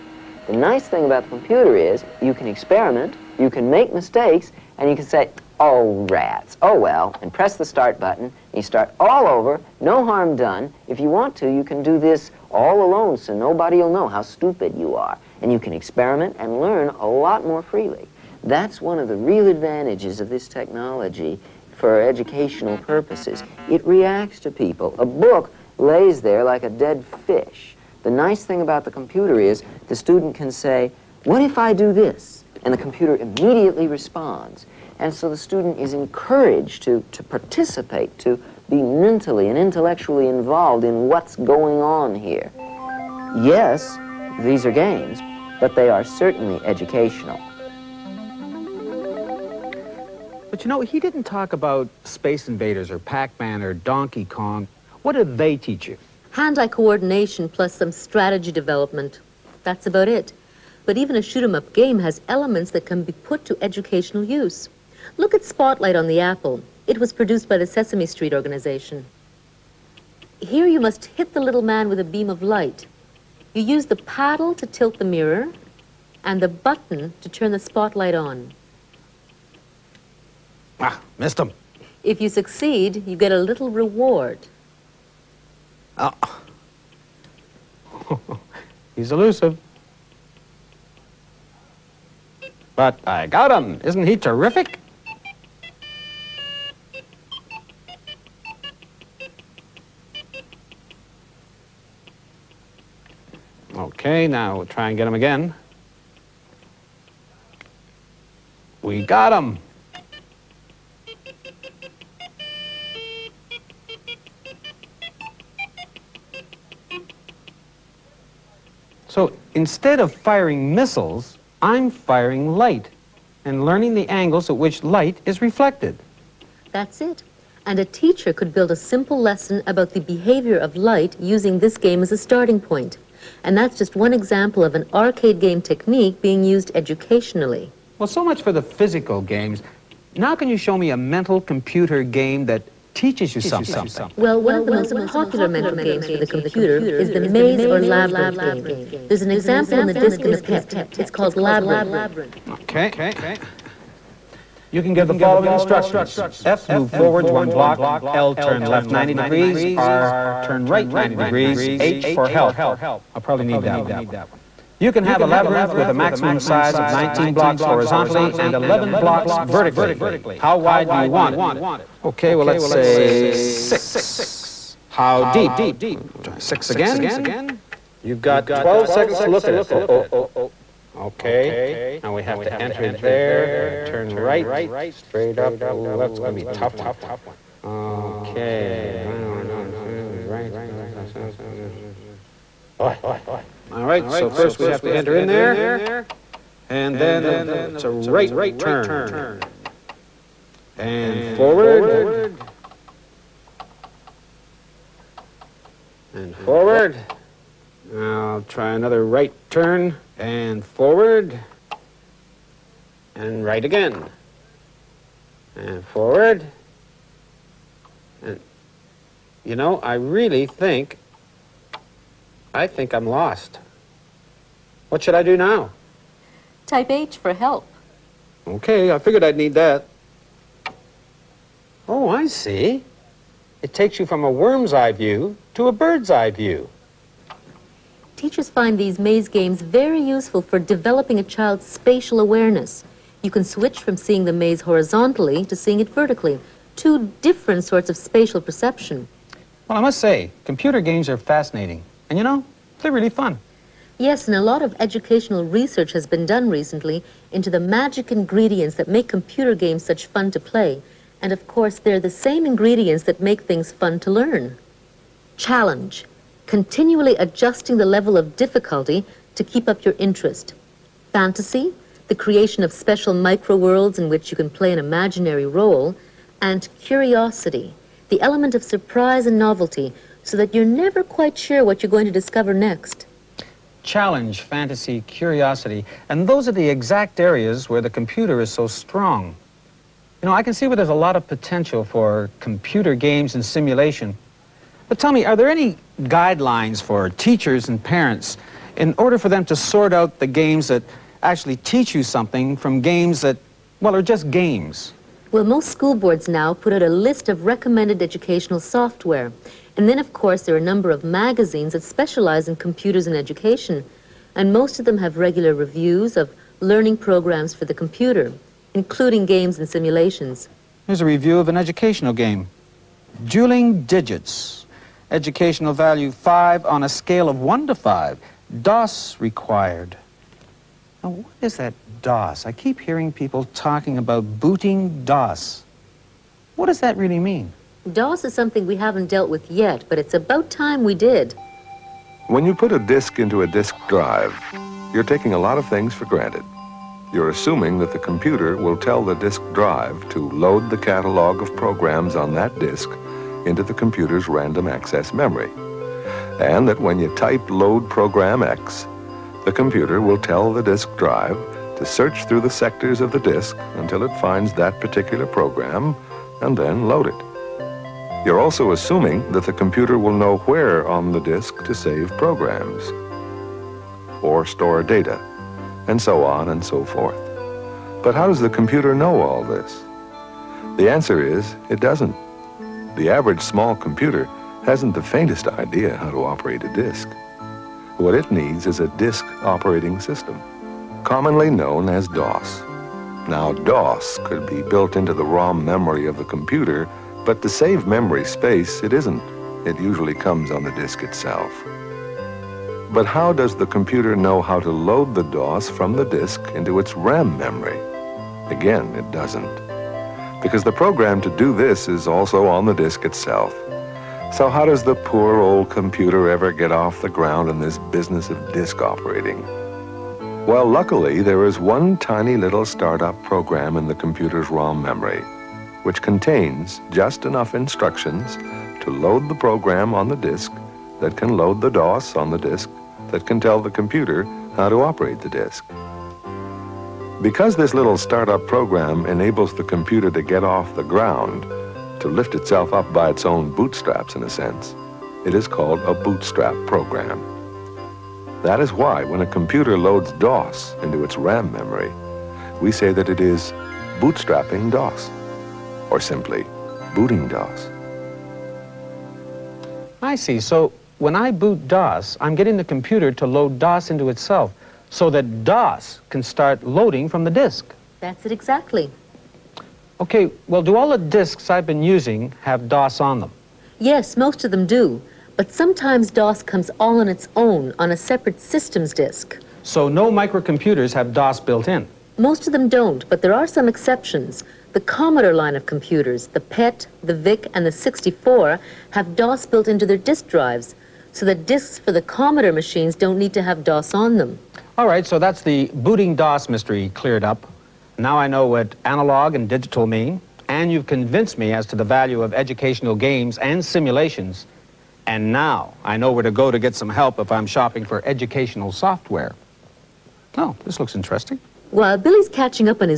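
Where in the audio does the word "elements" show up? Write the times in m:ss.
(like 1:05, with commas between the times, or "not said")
1:02, 4:38.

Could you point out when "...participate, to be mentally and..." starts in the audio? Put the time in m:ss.
0:37.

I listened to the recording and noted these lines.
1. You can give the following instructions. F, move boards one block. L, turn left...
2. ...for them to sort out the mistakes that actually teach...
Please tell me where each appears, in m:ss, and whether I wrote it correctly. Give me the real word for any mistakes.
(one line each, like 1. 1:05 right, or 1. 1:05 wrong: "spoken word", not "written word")
1. 2:34 wrong: "forwards", not "boards"
2. 4:59 wrong: "games", not "mistakes".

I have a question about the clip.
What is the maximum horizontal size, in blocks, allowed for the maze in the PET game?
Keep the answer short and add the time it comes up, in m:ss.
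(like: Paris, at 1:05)
19, at 2:46.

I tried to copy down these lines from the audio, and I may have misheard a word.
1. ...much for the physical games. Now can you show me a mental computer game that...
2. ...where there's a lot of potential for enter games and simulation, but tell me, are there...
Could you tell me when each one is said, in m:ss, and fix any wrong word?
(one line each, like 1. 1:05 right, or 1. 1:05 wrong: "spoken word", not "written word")
1. 2:18 right
2. 4:50 wrong: "computer", not "enter".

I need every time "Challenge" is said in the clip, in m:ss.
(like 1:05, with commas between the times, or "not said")
4:25, 4:43.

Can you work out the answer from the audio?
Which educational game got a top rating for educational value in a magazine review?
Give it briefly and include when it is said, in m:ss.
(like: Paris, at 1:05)
Dueling Digits, at 5:23.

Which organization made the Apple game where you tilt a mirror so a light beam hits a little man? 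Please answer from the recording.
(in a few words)
Sesame Street.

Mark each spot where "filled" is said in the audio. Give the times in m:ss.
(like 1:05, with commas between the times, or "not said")
not said.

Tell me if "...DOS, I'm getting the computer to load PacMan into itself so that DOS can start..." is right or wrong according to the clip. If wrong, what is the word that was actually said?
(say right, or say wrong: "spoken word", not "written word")
wrong: "DOS", not "PacMan".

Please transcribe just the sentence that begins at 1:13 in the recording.
You use the paddle to tilt the mirror and the button to turn the spotlight on.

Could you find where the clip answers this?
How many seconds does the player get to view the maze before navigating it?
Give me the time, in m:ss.
2:58.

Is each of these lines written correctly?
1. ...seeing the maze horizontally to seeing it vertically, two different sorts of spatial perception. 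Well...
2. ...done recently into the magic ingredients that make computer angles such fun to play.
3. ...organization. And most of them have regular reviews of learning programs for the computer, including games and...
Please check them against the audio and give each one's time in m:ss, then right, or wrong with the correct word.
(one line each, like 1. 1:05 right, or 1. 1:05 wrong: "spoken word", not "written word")
1. 4:03 right
2. 4:16 wrong: "games", not "angles"
3. 5:13 wrong: "education", not "organization".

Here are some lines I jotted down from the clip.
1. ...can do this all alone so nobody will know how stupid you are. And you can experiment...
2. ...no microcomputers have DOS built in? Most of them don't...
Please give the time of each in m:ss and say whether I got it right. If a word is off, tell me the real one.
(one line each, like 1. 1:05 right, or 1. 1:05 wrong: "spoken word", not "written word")
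1. 0:11 right
2. 7:59 right.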